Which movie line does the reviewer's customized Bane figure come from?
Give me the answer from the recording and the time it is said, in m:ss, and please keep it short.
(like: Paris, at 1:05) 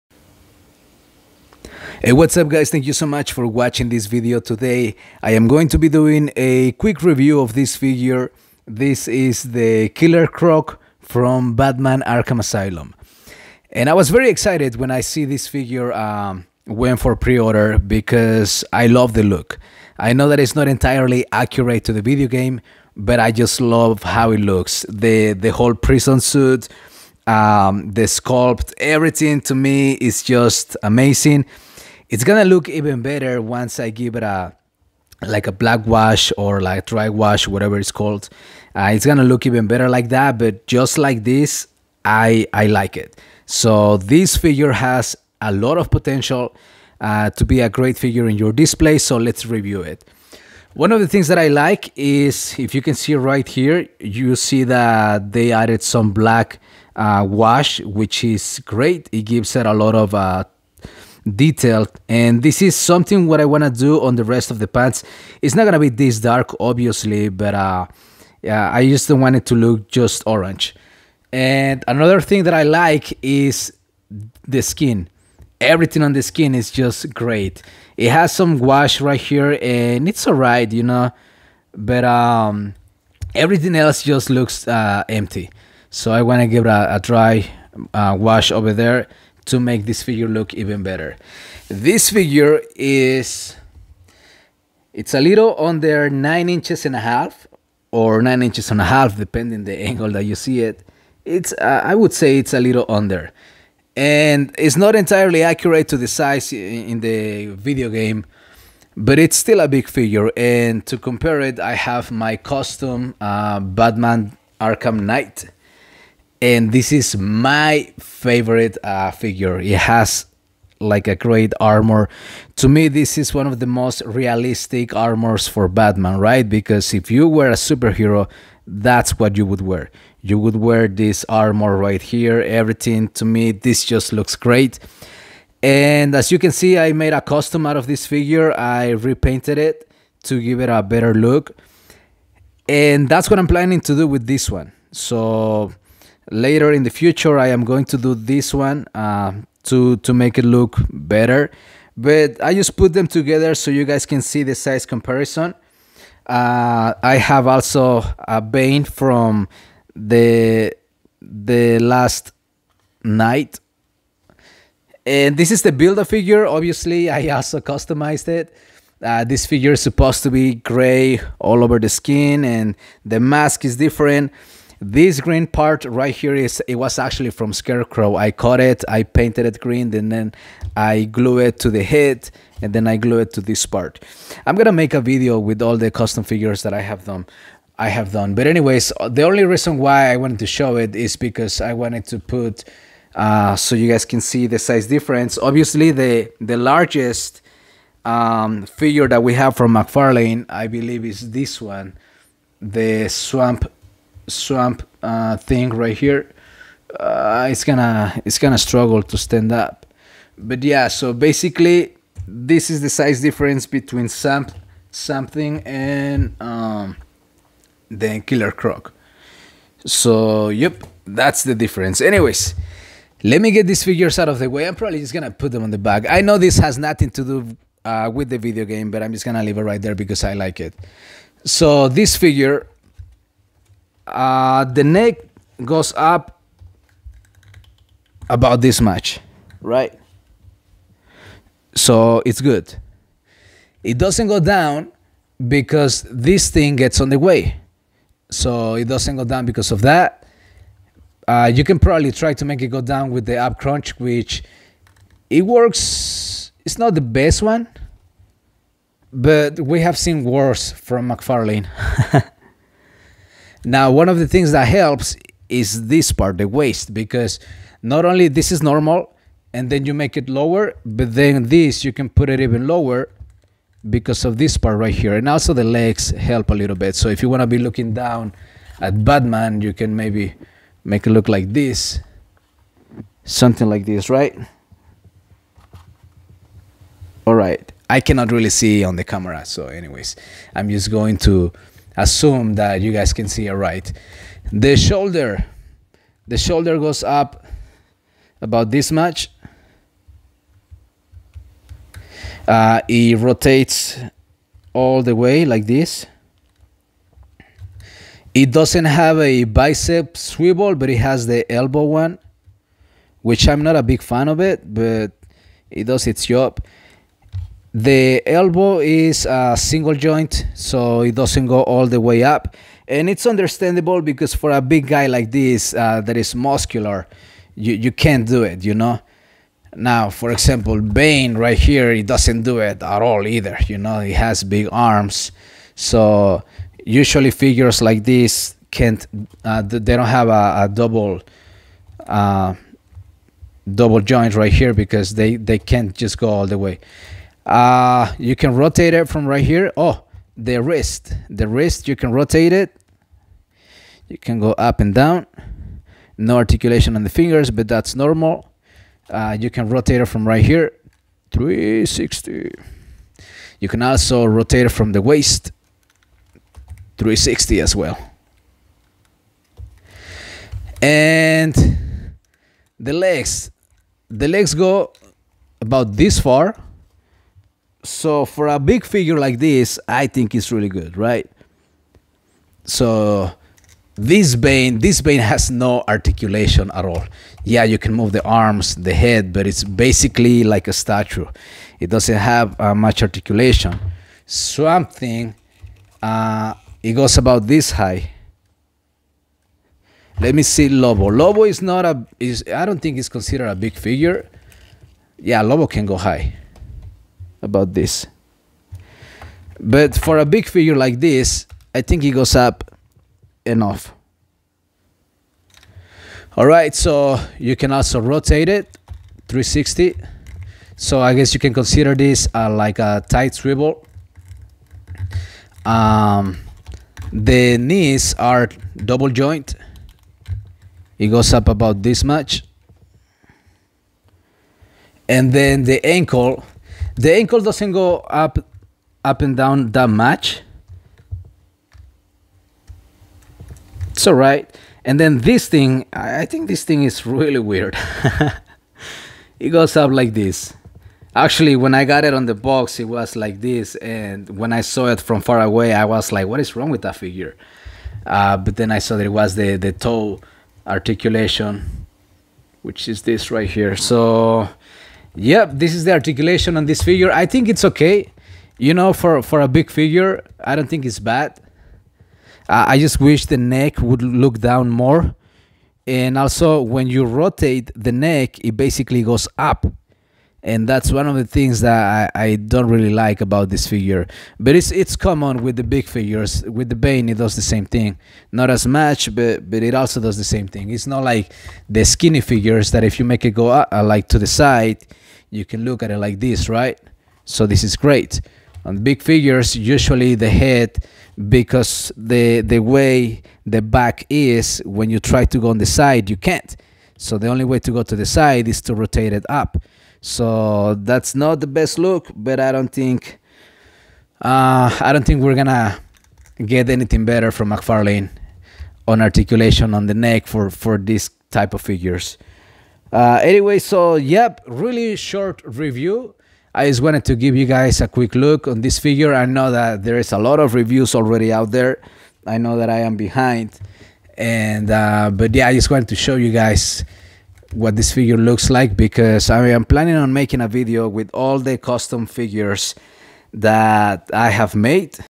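The Last Knight, at 2:41.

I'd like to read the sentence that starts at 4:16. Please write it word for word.
It's not the best one, but we have seen worse from McFarlane.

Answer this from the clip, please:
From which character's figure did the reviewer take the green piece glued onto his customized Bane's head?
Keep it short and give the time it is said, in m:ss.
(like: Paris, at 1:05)
Scarecrow, at 2:57.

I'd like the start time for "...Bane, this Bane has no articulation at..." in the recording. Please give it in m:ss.
6:24.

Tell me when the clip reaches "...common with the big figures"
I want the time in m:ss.
8:04.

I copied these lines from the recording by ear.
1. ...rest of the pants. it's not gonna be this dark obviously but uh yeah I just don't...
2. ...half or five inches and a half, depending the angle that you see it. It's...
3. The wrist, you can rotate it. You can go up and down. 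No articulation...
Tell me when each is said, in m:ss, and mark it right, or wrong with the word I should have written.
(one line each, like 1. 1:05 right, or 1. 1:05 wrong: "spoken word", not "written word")
1. 1:04 right
2. 1:36 wrong: "nine", not "five"
3. 5:51 right.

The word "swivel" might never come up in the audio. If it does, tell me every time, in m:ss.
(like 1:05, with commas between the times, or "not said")
5:10, 7:03.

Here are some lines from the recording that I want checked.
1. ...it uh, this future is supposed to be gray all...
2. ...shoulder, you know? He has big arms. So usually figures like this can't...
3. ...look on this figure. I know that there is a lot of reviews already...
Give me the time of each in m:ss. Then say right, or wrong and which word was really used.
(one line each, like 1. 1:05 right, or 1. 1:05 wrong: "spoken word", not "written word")
1. 2:48 wrong: "figure", not "future"
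2. 5:33 wrong: "either", not "shoulder"
3. 8:48 right.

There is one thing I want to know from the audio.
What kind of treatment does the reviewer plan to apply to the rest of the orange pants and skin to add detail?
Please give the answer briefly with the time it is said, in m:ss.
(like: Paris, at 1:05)
dry wash, at 0:36.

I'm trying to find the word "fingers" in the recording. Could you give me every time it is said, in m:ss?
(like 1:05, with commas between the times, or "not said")
5:57.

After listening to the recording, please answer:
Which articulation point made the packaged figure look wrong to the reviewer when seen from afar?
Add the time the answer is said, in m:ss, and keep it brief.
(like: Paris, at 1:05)
toe articulation, at 7:39.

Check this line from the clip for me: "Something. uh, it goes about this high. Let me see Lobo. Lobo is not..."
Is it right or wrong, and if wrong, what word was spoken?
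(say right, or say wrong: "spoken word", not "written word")
right.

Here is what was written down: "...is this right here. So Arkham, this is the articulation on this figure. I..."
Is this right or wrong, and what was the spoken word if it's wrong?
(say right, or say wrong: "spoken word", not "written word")
wrong: "Yep", not "Arkham".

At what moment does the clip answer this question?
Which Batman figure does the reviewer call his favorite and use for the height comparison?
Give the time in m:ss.
1:53.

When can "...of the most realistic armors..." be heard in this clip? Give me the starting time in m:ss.
2:03.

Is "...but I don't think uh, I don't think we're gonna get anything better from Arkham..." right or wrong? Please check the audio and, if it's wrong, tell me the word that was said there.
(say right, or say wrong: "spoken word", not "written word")
wrong: "McFarlane", not "Arkham".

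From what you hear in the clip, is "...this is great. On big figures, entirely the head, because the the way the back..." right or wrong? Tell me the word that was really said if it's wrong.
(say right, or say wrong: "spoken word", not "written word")
wrong: "usually", not "entirely".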